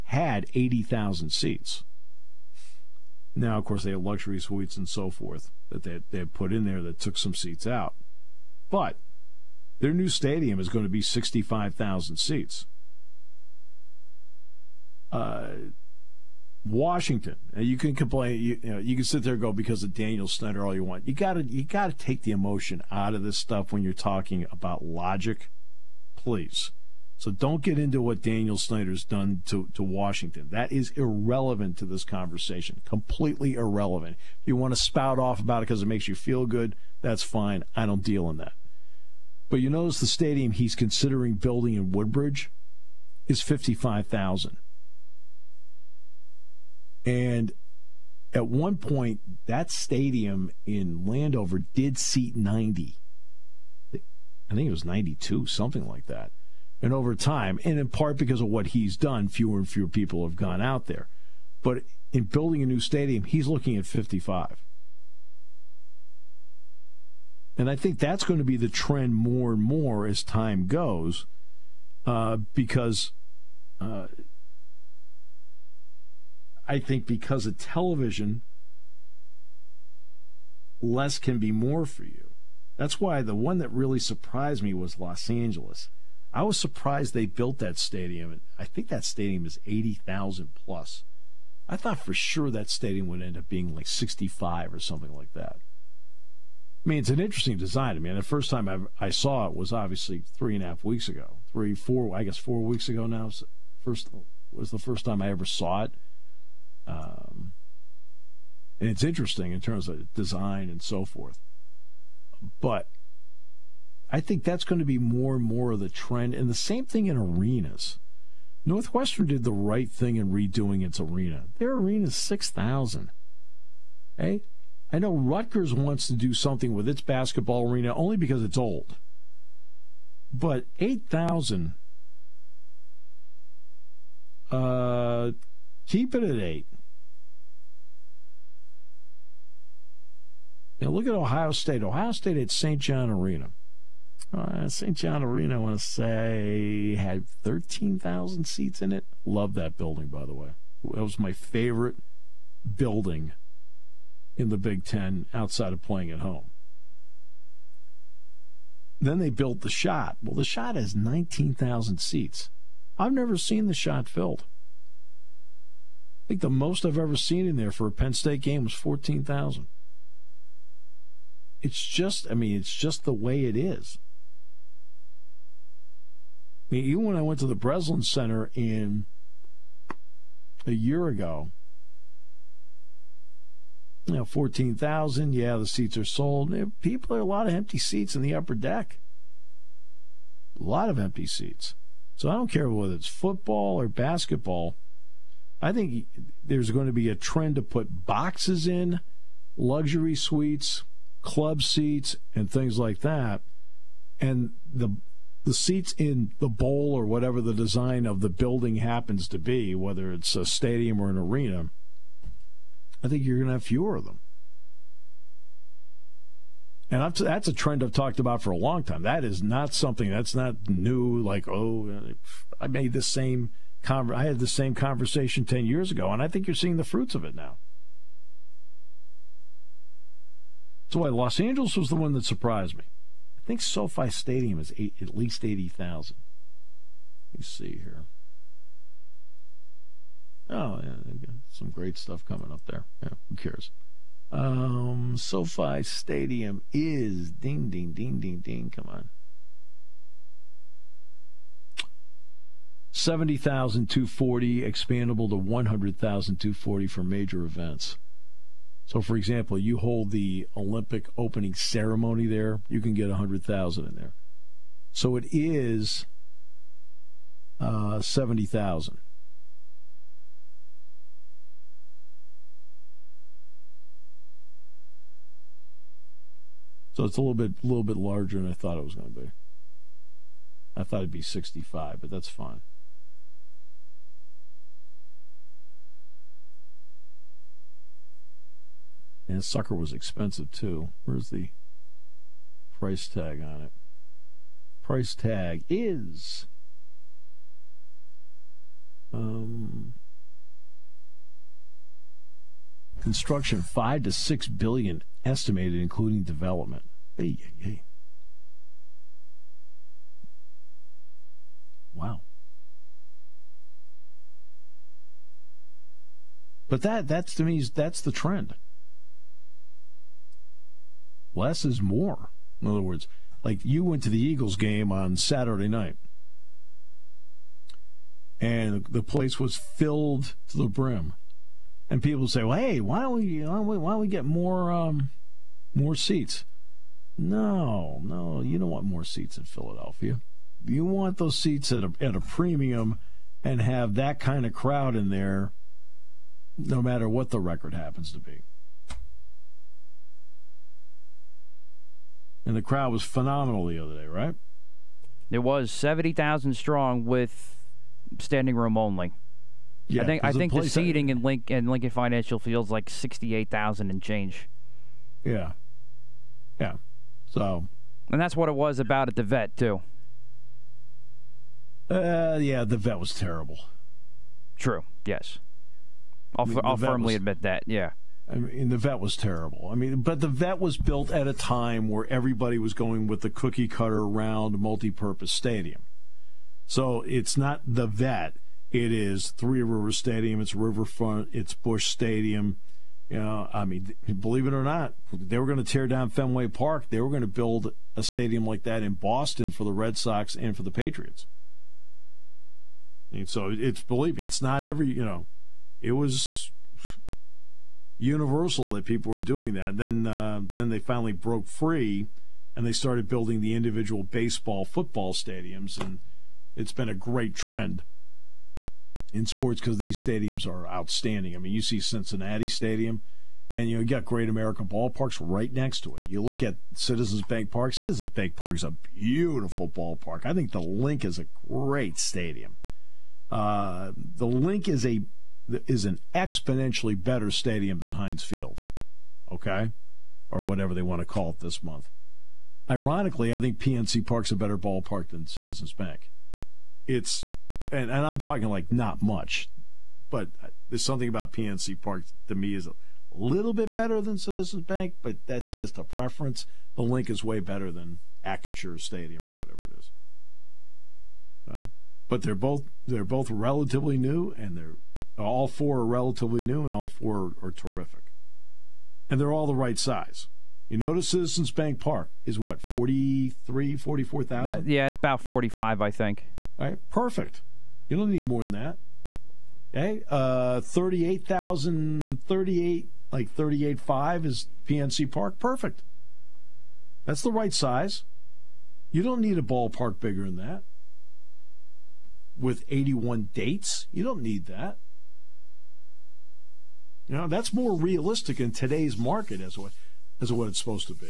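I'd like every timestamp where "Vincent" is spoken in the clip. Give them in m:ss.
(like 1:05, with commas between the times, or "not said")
not said.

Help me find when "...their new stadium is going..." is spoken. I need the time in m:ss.
0:09.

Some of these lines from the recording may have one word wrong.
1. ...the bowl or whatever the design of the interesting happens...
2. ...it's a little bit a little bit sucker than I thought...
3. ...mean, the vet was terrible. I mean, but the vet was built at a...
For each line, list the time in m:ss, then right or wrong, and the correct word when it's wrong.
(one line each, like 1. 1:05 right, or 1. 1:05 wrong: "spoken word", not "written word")
1. 3:26 wrong: "building", not "interesting"
2. 4:37 wrong: "larger", not "sucker"
3. 6:18 right.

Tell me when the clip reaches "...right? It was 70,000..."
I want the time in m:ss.
5:54.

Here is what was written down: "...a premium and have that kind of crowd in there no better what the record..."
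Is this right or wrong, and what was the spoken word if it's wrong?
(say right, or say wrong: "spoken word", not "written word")
wrong: "matter", not "better".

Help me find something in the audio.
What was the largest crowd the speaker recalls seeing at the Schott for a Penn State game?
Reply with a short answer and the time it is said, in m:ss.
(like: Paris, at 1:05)
14,000, at 2:48.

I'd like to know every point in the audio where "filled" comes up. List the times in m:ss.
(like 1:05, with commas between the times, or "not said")
2:44, 5:29.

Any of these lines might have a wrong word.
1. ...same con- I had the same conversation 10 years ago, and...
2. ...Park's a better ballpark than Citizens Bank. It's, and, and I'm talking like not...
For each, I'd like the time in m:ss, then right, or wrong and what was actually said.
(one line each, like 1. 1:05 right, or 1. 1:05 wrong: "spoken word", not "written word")
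1. 3:43 right
2. 7:24 right.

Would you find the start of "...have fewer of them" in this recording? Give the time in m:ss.
3:33.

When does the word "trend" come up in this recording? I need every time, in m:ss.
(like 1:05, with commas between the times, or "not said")
1:08, 1:55, 3:17, 3:37, 5:18, 6:57.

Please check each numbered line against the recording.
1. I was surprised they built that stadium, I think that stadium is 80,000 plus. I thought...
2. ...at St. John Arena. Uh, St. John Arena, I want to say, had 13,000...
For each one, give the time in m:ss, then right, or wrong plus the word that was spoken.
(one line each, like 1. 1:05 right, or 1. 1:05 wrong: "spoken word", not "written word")
1. 1:26 right
2. 2:22 right.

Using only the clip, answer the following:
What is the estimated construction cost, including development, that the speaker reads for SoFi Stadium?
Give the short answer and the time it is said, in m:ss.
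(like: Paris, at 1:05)
5 to 6 billion, at 5:03.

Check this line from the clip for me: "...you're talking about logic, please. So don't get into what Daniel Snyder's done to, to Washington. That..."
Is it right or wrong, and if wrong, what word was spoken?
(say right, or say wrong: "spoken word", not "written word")
right.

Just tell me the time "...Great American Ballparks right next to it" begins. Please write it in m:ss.
7:04.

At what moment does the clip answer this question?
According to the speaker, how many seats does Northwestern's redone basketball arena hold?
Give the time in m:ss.
2:02.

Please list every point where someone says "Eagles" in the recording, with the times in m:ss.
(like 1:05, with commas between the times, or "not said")
5:24.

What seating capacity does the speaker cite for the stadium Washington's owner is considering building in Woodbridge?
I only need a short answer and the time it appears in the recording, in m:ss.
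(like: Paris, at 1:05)
55,000, at 0:43.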